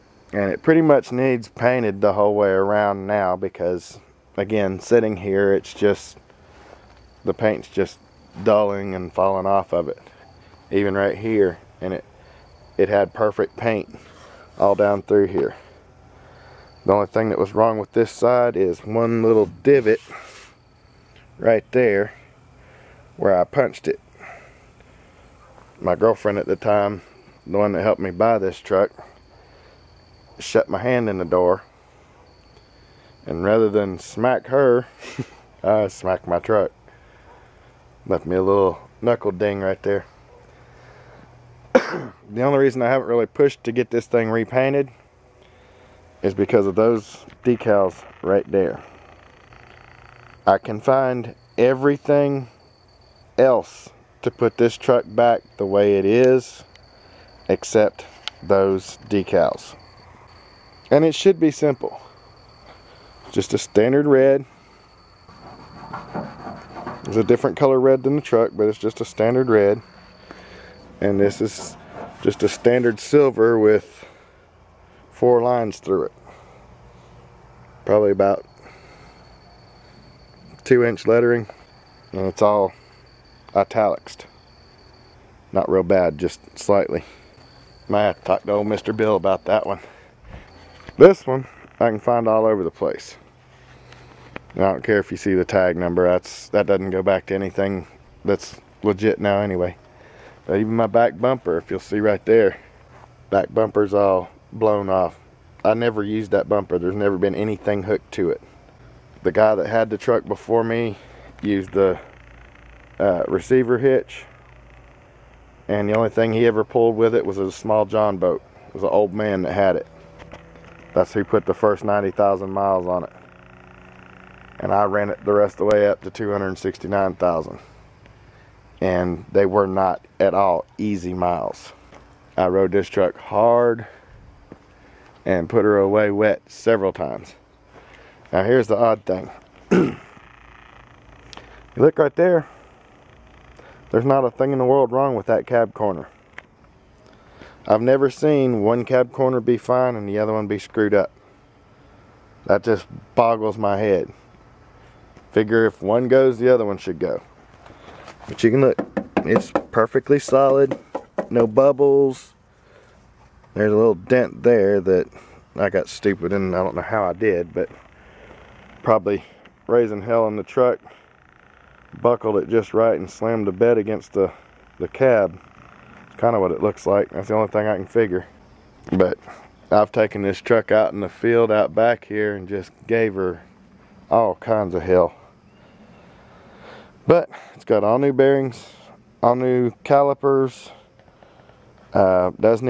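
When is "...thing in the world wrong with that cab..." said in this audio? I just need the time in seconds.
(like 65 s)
144 s.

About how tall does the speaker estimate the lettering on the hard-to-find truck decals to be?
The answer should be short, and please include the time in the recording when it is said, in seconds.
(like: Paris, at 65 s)
2 inch, at 80 s.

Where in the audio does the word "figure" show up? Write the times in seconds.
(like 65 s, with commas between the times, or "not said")
155 s, 177 s.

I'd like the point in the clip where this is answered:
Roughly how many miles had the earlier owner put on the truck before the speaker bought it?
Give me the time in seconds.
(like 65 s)
121 s.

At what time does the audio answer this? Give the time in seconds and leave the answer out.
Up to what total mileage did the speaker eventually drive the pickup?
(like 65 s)
126 s.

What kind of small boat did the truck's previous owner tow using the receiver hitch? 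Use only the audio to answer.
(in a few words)
John boat.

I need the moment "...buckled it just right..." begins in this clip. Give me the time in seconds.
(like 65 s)
172 s.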